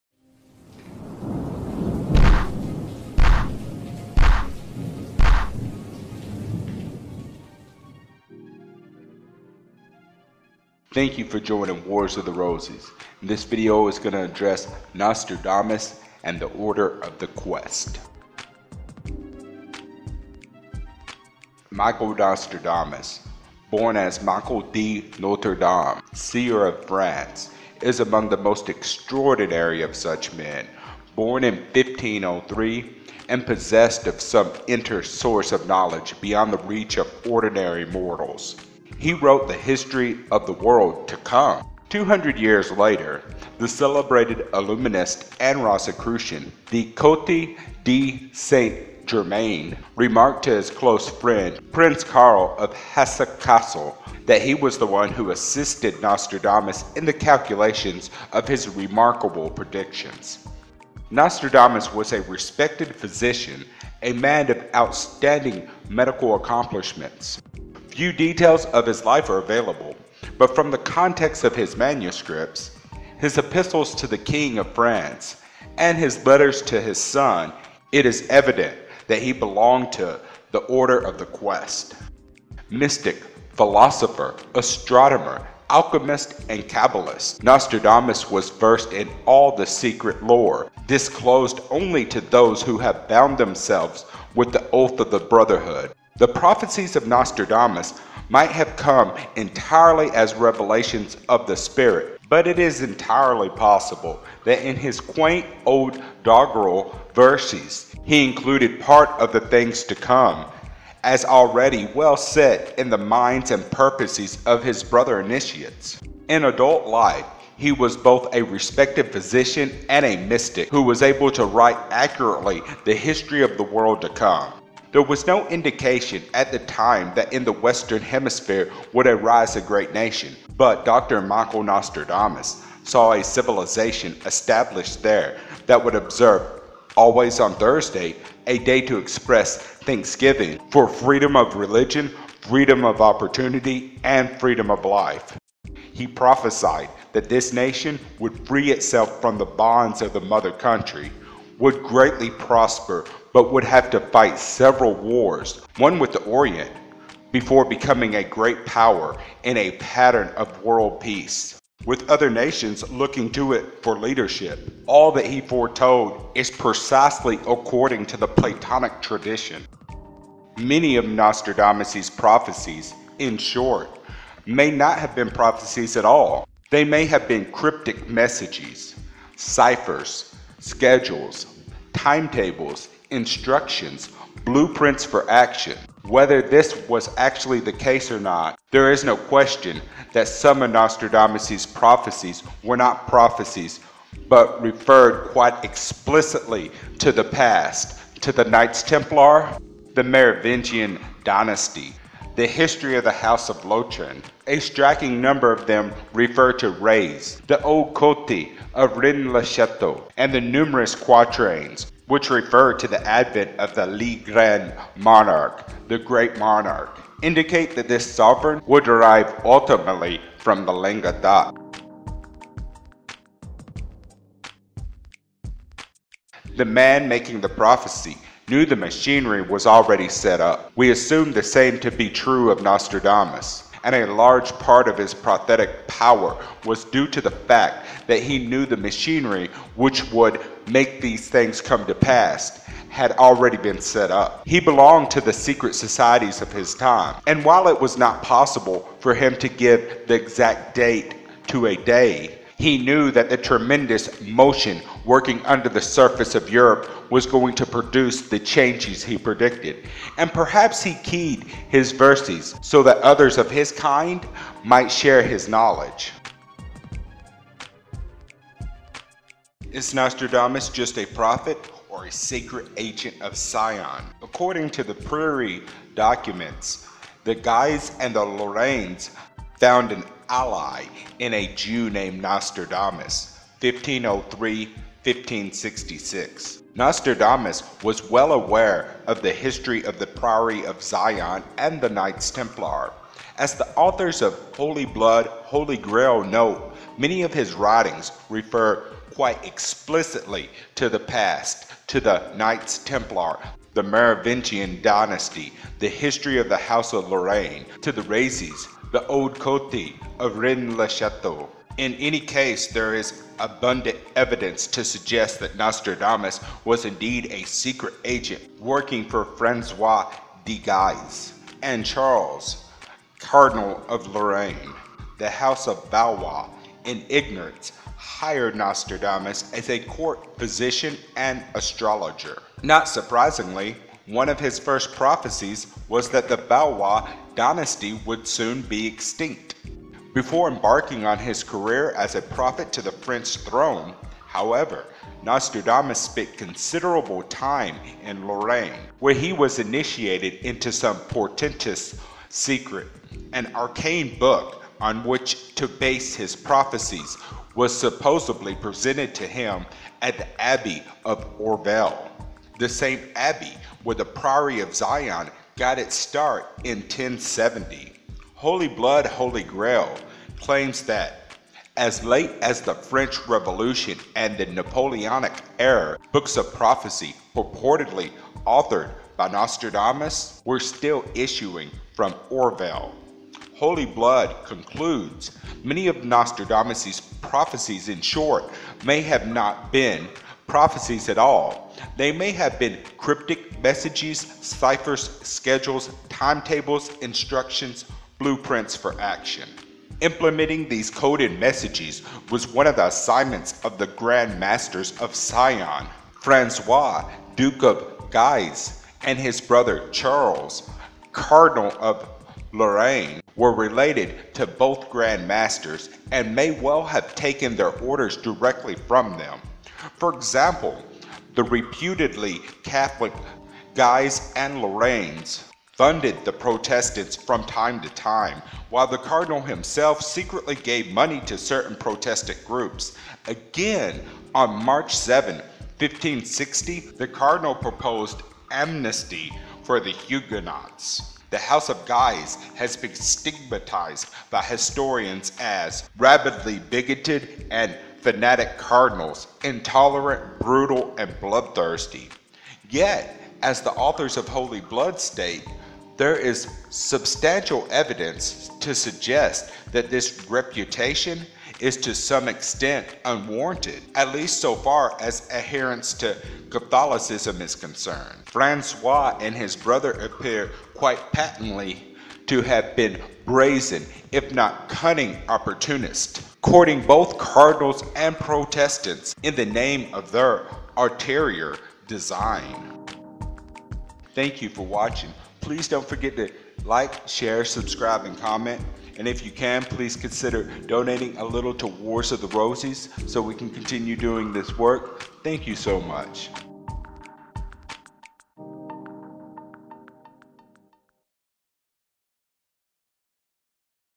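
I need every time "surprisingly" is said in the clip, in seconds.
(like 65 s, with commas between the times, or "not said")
332 s.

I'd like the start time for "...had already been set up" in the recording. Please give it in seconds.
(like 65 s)
242 s.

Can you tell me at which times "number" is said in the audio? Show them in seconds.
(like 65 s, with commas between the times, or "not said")
205 s.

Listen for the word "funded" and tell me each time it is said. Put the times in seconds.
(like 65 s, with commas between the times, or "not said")
425 s.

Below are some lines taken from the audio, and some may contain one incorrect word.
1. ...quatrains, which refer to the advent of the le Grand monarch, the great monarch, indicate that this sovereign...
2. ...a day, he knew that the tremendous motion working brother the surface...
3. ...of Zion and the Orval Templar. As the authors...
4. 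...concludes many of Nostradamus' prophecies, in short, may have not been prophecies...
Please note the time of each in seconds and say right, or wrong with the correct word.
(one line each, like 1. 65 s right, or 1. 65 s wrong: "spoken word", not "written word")
1. 210 s right
2. 251 s wrong: "under", not "brother"
3. 290 s wrong: "Knights", not "Orval"
4. 384 s right.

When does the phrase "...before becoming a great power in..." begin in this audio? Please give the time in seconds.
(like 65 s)
157 s.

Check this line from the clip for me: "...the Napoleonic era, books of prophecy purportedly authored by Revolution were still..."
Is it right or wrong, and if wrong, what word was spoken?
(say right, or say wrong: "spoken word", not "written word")
wrong: "Nostradamus", not "Revolution".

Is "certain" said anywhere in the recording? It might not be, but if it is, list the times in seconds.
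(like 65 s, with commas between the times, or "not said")
431 s.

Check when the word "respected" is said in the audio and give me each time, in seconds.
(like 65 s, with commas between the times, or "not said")
62 s, 118 s.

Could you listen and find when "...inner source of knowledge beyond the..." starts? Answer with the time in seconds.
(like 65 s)
34 s.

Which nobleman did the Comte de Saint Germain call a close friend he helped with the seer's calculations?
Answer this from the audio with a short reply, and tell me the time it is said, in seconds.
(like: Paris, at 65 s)
Prince Karl of Hesse Kassel, at 51 s.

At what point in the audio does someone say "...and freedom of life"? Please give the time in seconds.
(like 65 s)
144 s.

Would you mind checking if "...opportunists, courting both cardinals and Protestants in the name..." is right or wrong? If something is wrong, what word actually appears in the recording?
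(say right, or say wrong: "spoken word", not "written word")
right.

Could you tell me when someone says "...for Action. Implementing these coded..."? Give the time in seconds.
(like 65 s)
398 s.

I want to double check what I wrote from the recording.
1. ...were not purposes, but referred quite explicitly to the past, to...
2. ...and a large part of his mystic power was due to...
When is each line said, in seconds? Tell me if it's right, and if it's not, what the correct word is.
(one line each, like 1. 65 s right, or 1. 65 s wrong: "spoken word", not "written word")
1. 192 s wrong: "prophecies", not "purposes"
2. 233 s wrong: "prophetic", not "mystic".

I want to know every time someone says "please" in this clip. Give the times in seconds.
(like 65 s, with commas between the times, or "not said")
485 s, 489 s.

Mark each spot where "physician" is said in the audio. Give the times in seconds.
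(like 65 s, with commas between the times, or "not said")
62 s, 119 s, 330 s.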